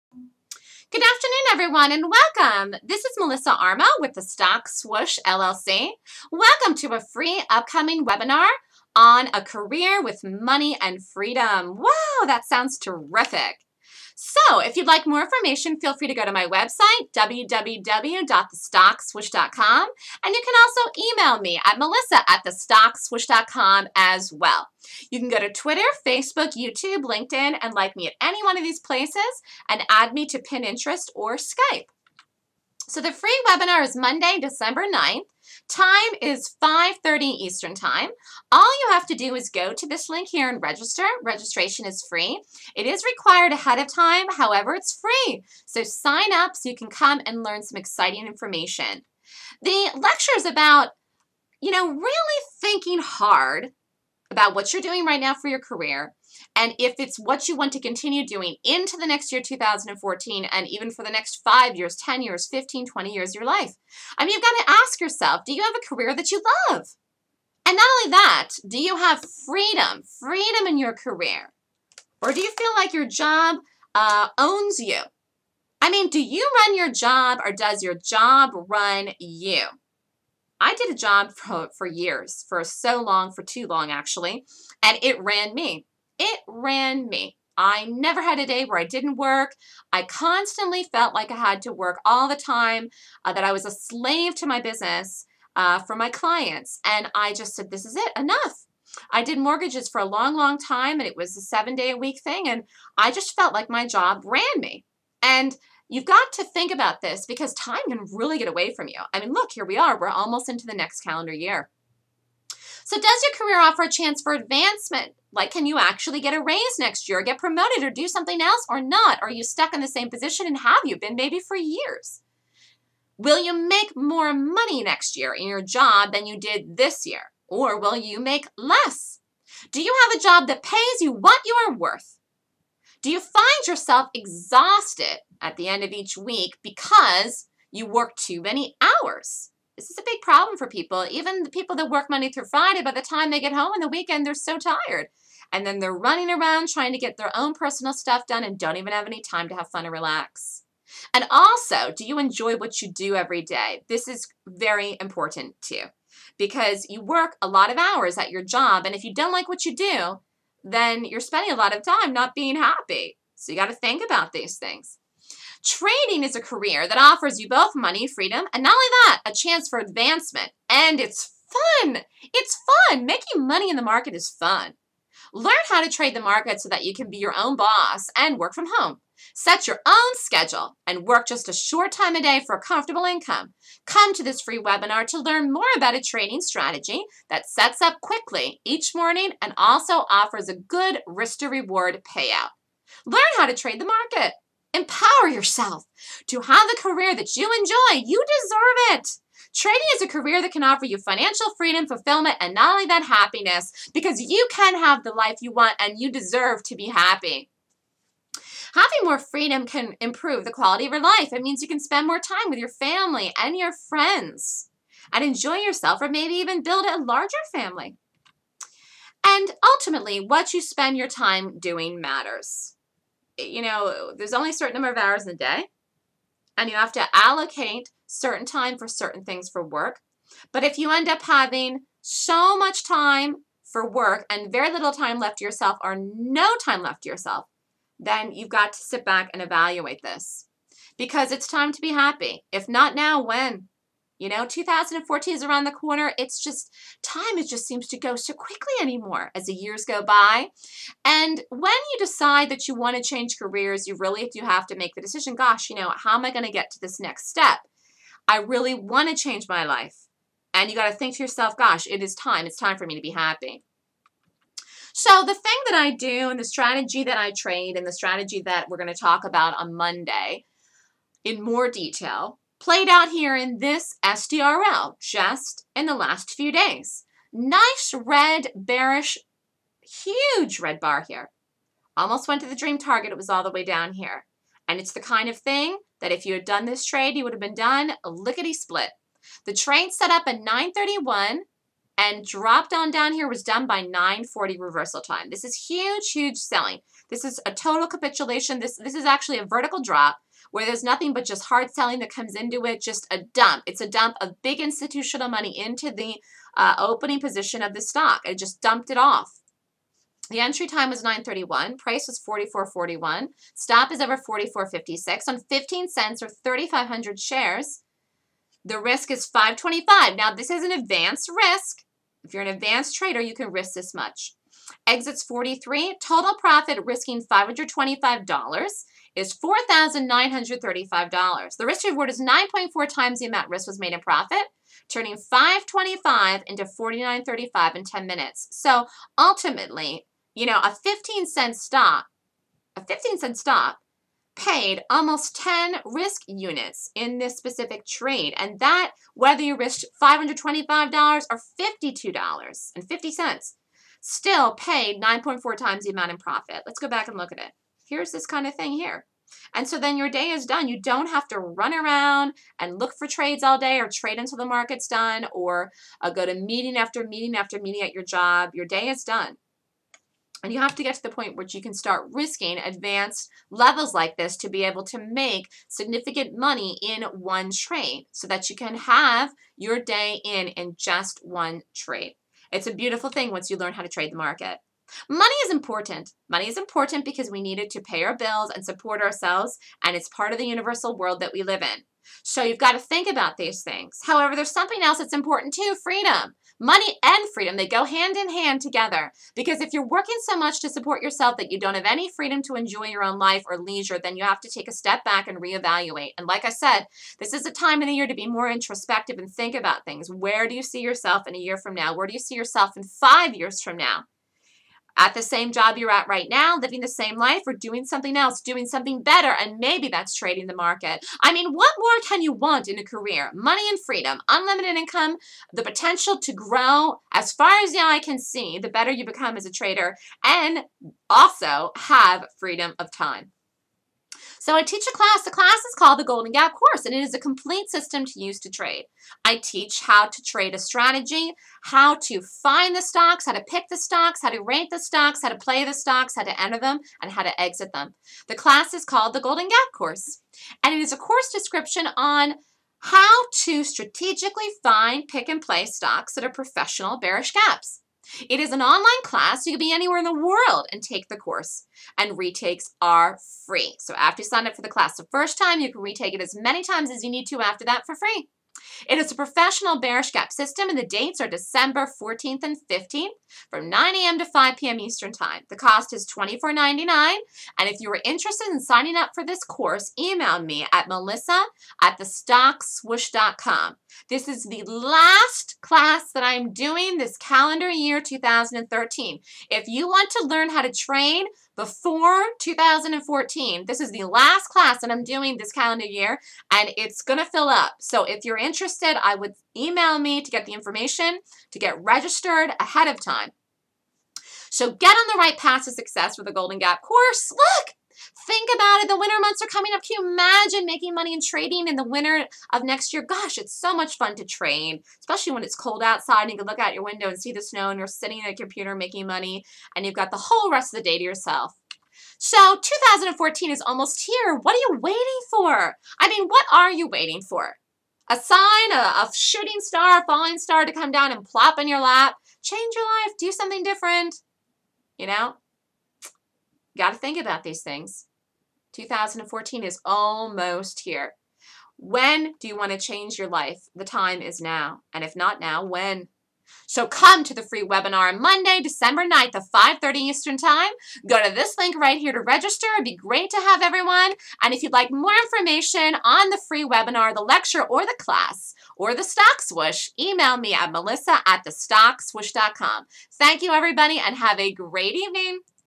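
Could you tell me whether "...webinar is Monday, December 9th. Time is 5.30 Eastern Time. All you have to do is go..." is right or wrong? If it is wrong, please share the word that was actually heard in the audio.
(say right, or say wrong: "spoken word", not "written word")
right.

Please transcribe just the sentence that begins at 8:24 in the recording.
So get on the right path to success for the Golden Gap course.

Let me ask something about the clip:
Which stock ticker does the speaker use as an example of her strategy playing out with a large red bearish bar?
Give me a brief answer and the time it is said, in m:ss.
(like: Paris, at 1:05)
SDRL, at 4:34.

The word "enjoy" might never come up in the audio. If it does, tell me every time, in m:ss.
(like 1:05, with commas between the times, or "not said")
2:32, 3:17, 3:35, 6:42.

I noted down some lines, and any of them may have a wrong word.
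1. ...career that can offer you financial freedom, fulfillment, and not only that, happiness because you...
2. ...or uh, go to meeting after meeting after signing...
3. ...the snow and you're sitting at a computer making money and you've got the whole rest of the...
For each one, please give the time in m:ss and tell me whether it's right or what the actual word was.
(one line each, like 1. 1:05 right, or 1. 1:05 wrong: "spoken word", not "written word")
1. 3:20 right
2. 6:05 wrong: "meeting", not "signing"
3. 8:37 right.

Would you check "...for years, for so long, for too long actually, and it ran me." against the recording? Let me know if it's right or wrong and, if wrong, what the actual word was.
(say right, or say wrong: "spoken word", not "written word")
right.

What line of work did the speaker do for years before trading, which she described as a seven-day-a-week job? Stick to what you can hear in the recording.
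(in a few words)
Mortgages.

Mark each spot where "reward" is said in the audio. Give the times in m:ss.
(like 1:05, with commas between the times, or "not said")
3:11, 5:31.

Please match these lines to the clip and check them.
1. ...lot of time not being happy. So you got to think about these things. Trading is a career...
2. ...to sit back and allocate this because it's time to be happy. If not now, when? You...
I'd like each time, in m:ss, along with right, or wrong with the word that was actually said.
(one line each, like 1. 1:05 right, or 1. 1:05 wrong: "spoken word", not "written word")
1. 2:41 right
2. 3:58 wrong: "evaluate", not "allocate".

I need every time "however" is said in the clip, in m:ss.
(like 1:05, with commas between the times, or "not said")
0:44, 6:34.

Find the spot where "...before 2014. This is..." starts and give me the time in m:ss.
8:11.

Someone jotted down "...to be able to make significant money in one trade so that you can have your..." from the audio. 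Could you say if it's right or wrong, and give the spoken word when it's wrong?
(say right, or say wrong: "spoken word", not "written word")
right.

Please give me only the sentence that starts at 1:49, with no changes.
I mean, look, here we are.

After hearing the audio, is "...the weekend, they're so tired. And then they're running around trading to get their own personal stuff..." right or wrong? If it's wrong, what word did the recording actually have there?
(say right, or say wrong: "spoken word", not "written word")
wrong: "trying", not "trading".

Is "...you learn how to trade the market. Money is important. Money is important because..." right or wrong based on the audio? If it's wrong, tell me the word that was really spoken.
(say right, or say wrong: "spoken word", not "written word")
right.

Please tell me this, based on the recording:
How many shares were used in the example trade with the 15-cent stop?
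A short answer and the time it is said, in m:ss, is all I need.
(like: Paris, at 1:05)
3,500, at 5:16.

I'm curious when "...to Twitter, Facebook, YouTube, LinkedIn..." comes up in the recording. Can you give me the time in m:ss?
0:25.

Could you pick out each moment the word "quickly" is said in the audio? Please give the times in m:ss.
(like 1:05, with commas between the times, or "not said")
3:08, 4:08.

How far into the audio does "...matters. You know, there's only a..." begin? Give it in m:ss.
3:41.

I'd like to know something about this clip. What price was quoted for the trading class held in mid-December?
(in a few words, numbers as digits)
$24.99.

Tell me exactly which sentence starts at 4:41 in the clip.
Almost went to the dream target.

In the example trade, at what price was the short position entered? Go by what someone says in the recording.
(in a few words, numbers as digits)
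44.41.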